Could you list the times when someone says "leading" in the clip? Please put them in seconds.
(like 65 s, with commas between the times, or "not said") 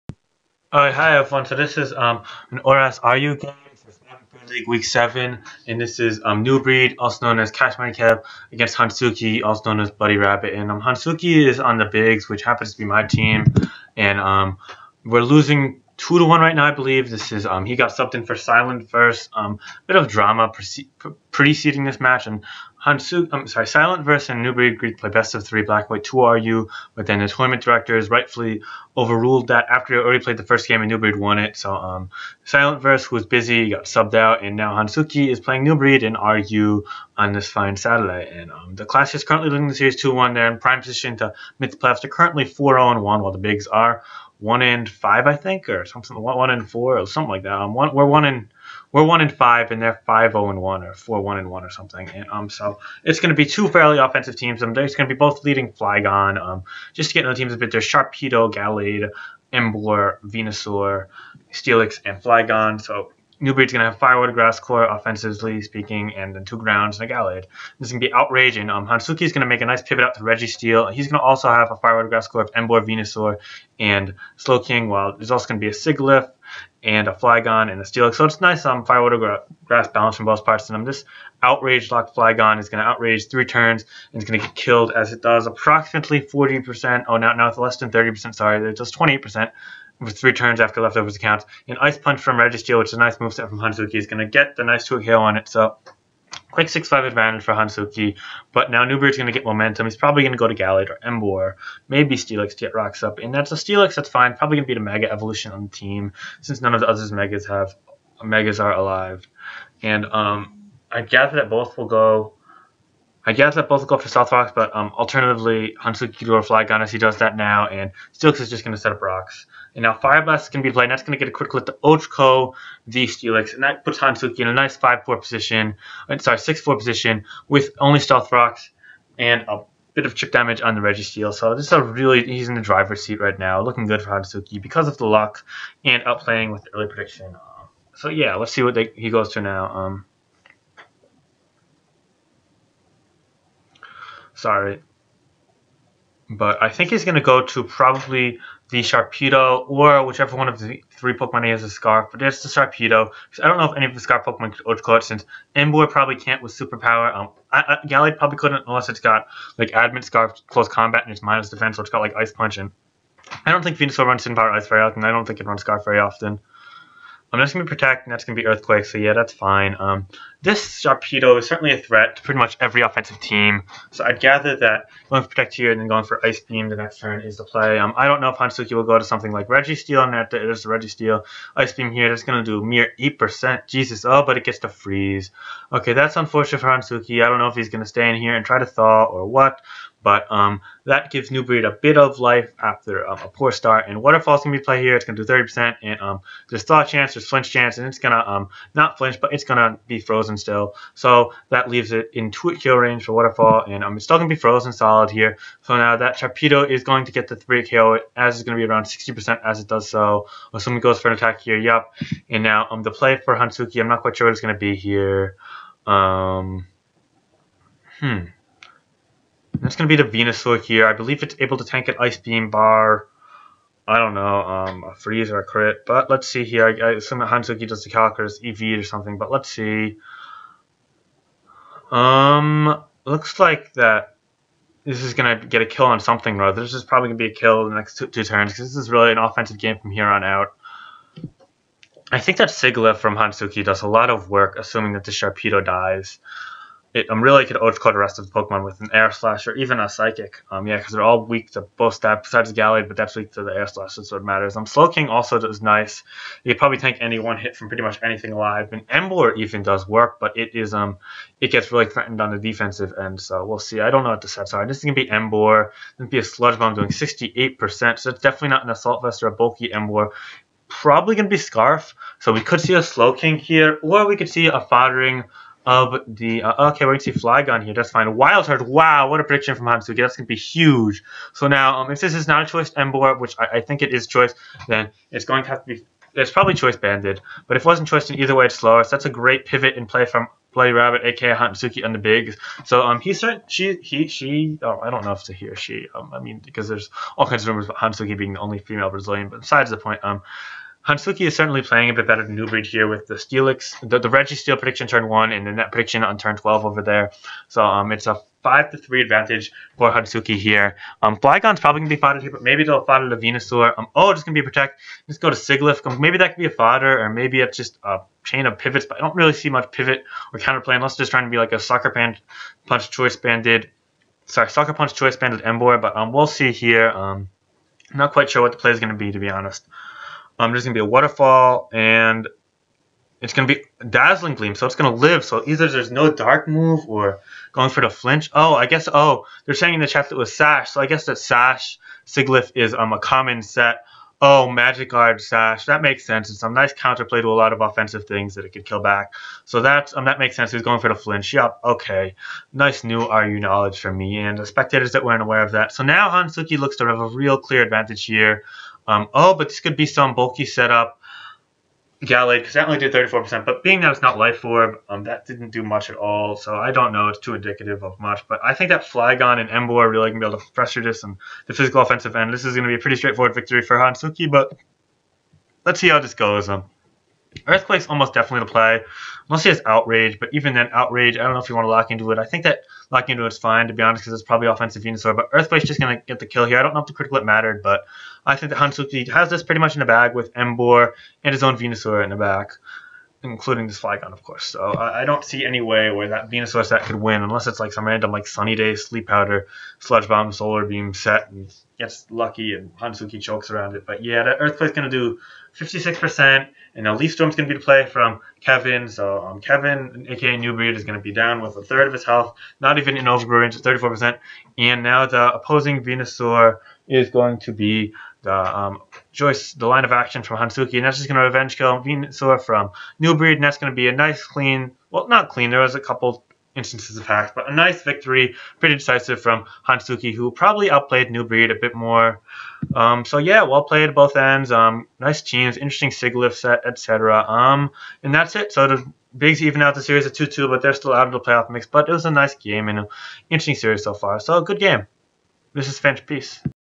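39 s, 55 s.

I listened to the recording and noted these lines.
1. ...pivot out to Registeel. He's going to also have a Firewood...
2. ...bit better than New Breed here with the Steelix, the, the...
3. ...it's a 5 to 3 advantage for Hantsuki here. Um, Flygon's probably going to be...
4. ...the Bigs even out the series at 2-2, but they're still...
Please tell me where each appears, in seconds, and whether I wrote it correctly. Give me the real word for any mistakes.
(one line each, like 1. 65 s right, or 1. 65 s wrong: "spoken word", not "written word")
1. 69 s right
2. 301 s right
3. 307 s right
4. 438 s right.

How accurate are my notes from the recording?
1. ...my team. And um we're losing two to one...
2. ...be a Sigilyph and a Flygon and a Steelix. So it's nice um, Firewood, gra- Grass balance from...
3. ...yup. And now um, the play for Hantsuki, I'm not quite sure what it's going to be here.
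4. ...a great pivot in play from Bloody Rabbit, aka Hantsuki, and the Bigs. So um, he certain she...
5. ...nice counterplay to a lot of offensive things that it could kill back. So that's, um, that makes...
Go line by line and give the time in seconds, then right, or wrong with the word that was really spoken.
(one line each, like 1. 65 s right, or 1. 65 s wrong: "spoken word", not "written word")
1. 12 s right
2. 75 s right
3. 211 s right
4. 289 s right
5. 346 s right.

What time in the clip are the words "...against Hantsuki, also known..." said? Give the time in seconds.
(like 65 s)
8 s.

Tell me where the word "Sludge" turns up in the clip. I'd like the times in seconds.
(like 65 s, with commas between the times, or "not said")
266 s, 399 s.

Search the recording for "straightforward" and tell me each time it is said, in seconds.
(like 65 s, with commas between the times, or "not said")
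372 s.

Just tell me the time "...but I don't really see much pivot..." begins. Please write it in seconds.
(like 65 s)
318 s.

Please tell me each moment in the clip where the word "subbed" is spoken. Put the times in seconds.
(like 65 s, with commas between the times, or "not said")
17 s, 33 s.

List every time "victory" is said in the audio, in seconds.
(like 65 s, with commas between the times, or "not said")
373 s, 427 s.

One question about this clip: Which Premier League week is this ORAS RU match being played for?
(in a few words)
Week 7.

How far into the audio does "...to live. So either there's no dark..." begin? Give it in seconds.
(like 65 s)
334 s.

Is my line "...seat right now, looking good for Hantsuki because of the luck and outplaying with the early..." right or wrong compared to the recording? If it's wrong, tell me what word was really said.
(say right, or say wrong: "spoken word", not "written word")
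right.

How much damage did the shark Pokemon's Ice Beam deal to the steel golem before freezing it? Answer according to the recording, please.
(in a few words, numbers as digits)
8%.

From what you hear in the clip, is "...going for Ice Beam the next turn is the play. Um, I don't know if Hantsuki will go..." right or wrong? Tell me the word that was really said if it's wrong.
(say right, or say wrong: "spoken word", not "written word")
right.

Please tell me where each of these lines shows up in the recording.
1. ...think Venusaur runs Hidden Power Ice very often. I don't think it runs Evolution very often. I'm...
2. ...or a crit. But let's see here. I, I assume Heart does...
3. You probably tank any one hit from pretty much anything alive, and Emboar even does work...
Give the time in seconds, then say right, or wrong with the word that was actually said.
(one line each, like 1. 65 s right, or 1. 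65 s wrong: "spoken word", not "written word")
1. 163 s wrong: "Scarf", not "Evolution"
2. 225 s wrong: "Hantsuki", not "Heart"
3. 256 s right.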